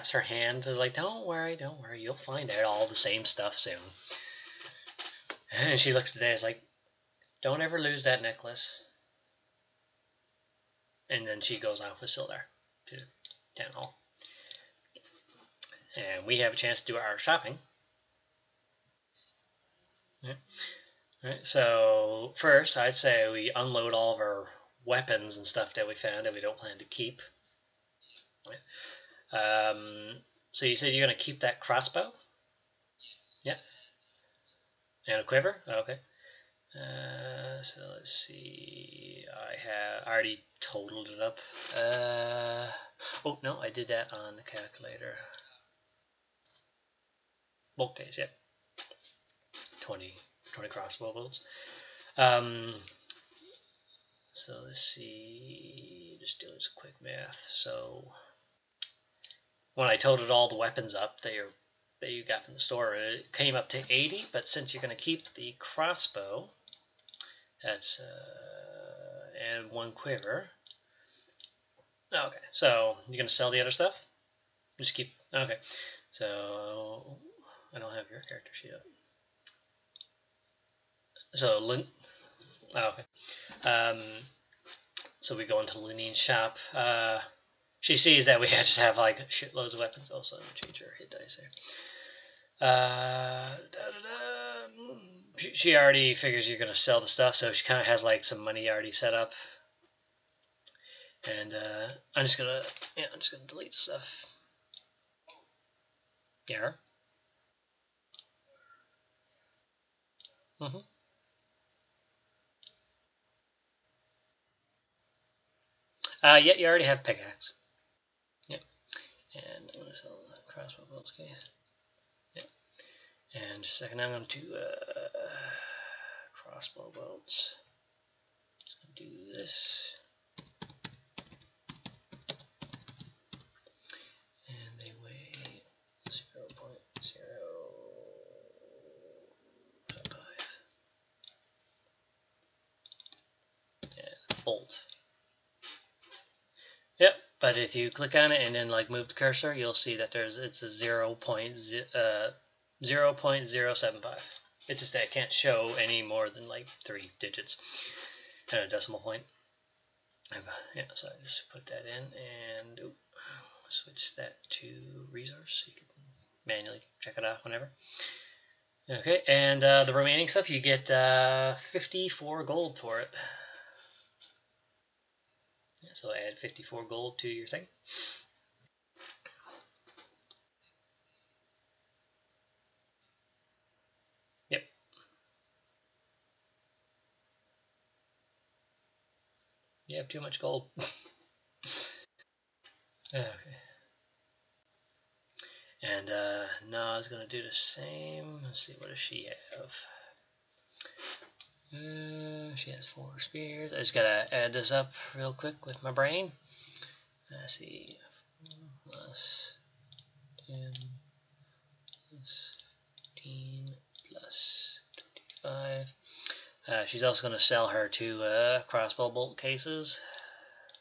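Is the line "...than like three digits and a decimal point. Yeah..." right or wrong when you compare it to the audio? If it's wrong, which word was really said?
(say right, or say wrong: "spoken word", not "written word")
right.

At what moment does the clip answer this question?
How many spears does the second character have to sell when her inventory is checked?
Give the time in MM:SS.
03:22.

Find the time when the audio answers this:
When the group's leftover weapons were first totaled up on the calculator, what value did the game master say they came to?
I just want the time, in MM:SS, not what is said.
01:03.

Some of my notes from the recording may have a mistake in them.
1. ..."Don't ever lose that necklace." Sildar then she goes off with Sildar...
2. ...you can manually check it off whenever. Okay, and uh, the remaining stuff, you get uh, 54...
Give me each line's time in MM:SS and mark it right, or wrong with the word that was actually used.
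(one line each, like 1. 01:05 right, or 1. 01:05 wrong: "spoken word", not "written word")
1. 00:07 wrong: "And", not "Sildar"
2. 02:45 right.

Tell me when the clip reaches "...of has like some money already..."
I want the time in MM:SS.
01:37.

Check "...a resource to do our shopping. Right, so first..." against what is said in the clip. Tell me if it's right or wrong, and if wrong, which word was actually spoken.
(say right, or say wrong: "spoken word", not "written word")
wrong: "chance", not "resource".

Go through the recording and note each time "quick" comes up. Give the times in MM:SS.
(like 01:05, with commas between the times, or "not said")
00:56, 03:25.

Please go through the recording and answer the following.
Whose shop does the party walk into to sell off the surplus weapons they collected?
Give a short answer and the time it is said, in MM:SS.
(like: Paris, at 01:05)
Linene's, at 01:25.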